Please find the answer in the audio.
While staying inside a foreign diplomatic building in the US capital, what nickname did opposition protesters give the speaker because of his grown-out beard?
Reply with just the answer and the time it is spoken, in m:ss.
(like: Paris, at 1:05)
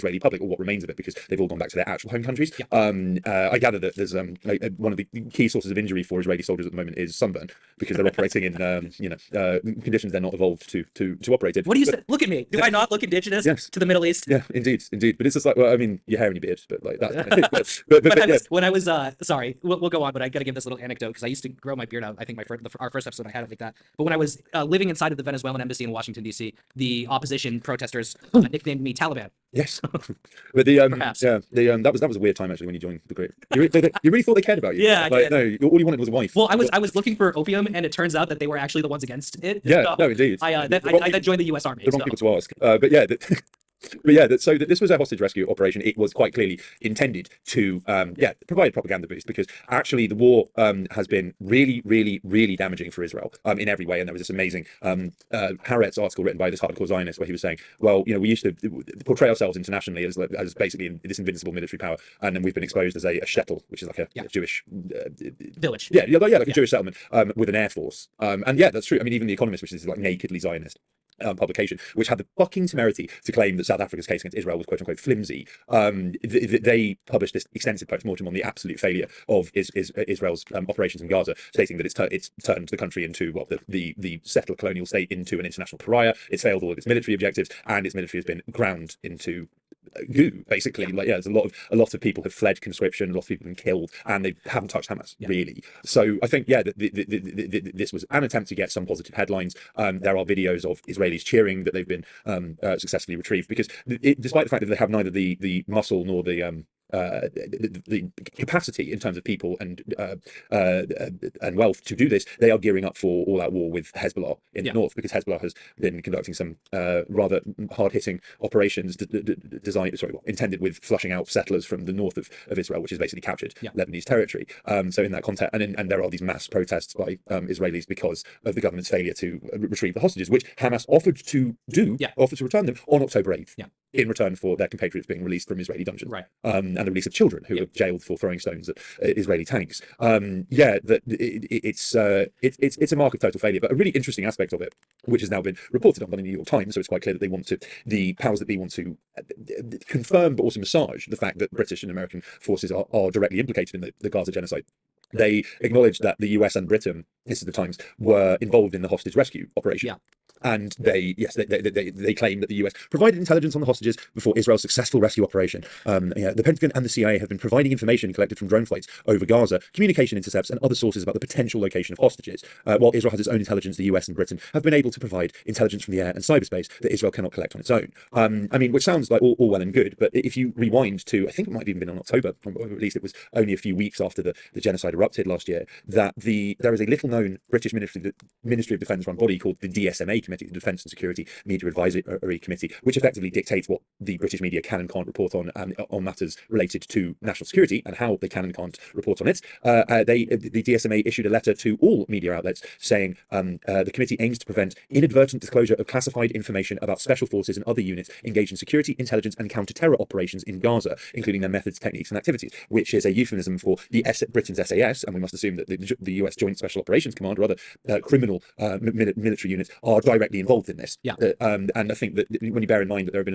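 Taliban, at 0:28.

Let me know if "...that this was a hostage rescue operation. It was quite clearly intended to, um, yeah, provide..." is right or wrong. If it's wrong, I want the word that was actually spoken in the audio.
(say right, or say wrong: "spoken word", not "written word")
right.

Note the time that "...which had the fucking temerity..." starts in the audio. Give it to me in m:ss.
1:11.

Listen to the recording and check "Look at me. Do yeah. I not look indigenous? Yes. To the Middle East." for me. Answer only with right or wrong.
right.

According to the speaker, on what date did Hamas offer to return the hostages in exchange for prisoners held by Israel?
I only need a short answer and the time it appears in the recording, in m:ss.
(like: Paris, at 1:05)
October 8, at 2:13.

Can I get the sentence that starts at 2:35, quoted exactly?
They acknowledged that the US and Britain, this is the Times, were involved in the hostage rescue operation.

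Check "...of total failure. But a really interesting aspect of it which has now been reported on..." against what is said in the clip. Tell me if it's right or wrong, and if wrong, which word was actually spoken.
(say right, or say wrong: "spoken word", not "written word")
right.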